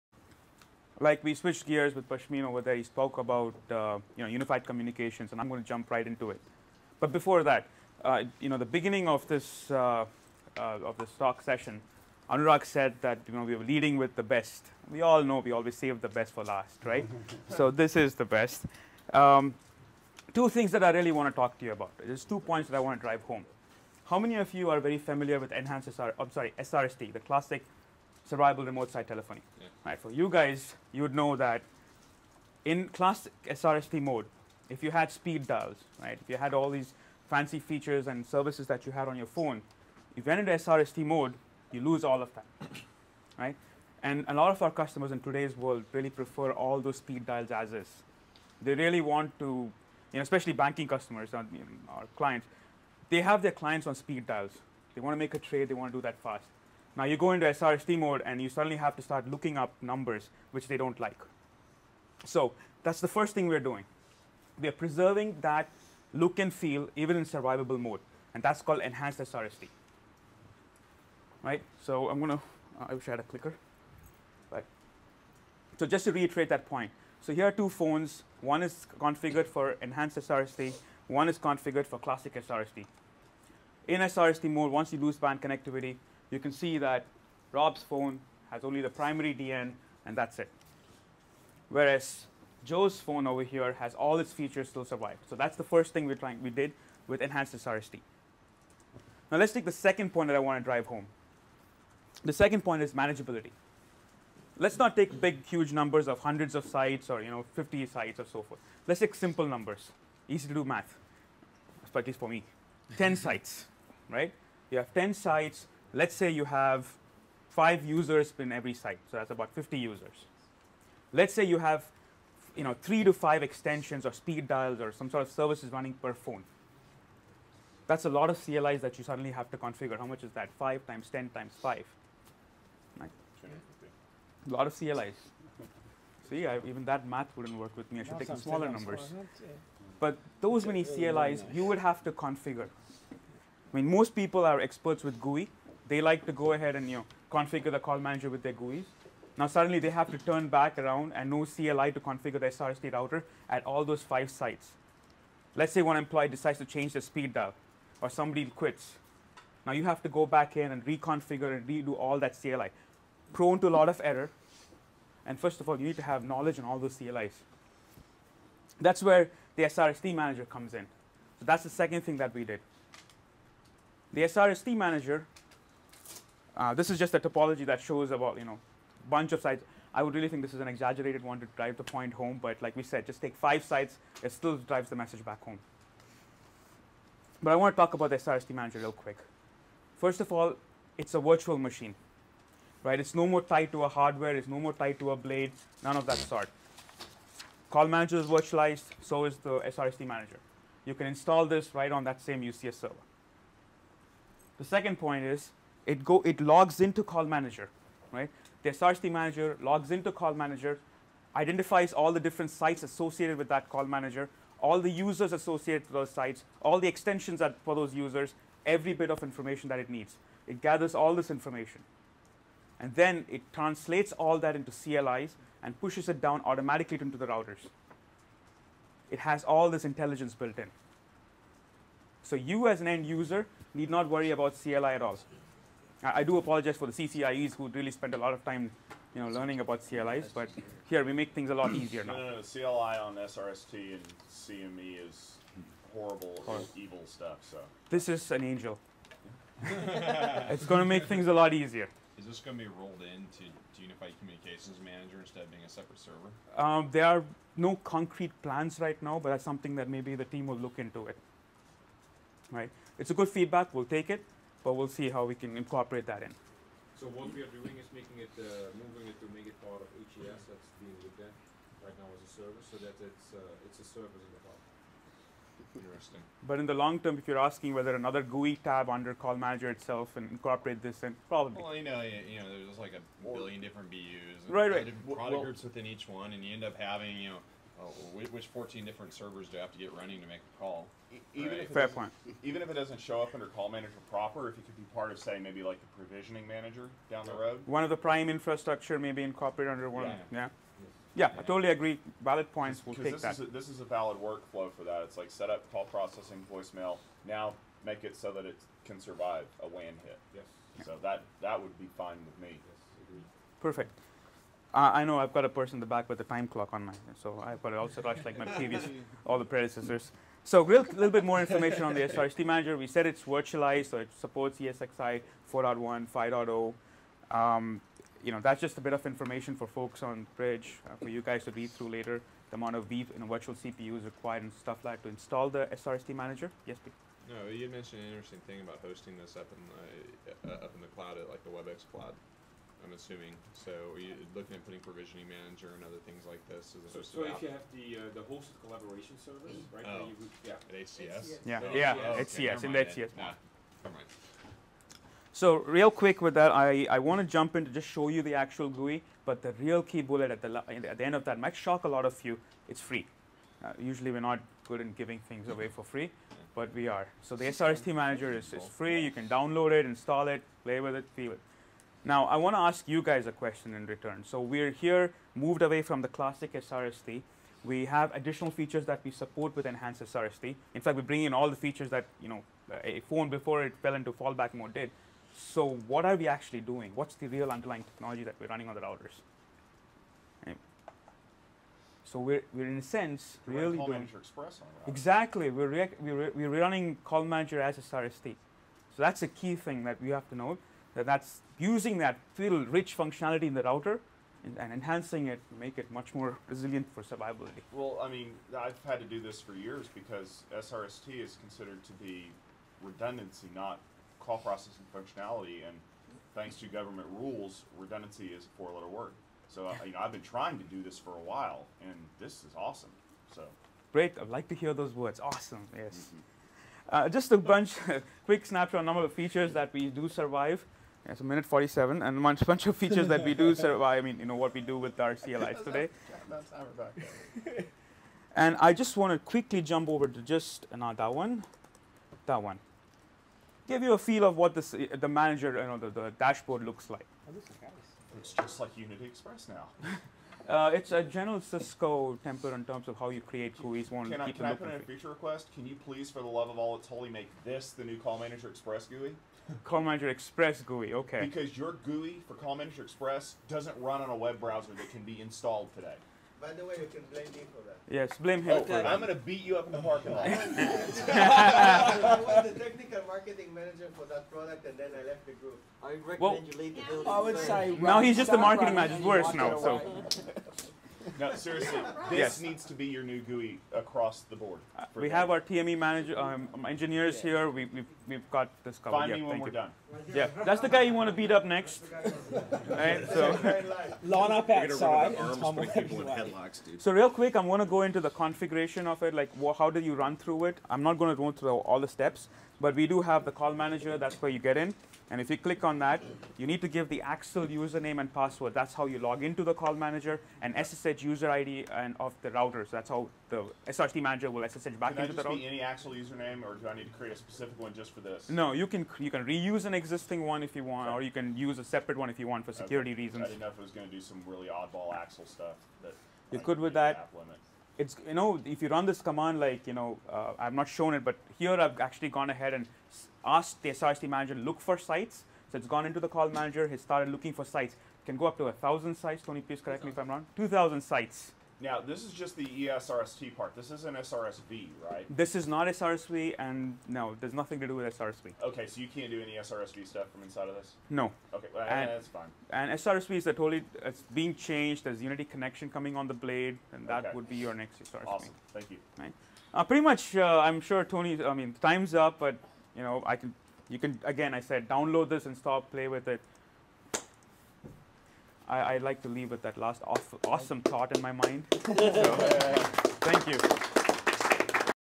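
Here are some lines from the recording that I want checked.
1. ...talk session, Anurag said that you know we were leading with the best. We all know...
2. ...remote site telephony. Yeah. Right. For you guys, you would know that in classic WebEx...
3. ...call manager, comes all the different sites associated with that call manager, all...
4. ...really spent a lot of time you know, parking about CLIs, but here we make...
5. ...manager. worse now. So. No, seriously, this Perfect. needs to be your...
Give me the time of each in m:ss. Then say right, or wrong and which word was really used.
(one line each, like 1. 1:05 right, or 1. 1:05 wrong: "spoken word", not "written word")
1. 0:11 right
2. 0:28 wrong: "SRST", not "WebEx"
3. 3:30 wrong: "identifies", not "comes"
4. 3:57 wrong: "learning", not "parking"
5. 7:58 wrong: "Yes", not "Perfect".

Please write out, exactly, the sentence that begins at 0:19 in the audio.
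Um, two things that I really want to talk to you about.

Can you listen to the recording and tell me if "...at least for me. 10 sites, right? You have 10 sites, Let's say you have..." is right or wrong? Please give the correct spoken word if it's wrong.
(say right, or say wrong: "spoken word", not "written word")
right.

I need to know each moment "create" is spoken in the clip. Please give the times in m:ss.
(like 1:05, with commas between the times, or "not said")
7:33, 8:36.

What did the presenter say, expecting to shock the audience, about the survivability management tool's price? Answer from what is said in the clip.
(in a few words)
It's free.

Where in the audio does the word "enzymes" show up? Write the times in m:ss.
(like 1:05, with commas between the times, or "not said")
not said.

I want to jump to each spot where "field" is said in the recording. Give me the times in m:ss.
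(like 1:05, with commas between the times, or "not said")
6:42.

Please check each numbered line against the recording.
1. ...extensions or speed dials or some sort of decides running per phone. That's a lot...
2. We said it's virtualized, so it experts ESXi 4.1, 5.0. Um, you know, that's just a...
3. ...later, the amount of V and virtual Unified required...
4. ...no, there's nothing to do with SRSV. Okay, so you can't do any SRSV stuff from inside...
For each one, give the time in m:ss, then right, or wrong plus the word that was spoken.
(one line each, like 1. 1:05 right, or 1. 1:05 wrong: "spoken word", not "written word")
1. 2:03 wrong: "services", not "decides"
2. 5:22 wrong: "supports", not "experts"
3. 5:31 wrong: "CPUs", not "Unified"
4. 9:06 right.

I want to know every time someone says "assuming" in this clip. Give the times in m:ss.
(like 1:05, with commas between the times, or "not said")
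5:42.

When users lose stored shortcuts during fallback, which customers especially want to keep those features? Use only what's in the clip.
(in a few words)
banking customers.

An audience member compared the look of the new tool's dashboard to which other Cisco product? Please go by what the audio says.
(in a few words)
Unity Express.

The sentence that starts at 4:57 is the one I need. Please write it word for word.
One of the prime infrastructure may be incorporated under one.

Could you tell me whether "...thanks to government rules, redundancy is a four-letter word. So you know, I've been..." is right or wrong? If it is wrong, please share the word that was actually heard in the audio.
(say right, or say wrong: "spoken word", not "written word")
right.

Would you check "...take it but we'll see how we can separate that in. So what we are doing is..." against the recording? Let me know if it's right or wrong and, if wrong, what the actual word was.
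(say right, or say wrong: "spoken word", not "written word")
wrong: "incorporate", not "separate".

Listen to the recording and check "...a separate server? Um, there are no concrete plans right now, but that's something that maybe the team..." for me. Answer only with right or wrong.
right.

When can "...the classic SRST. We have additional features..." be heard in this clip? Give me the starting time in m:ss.
6:16.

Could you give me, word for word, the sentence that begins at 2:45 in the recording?
And first of all, you need to have knowledge on all those CLIs.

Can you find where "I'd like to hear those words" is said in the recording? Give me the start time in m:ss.
7:04.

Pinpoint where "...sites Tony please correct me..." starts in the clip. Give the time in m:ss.
8:58.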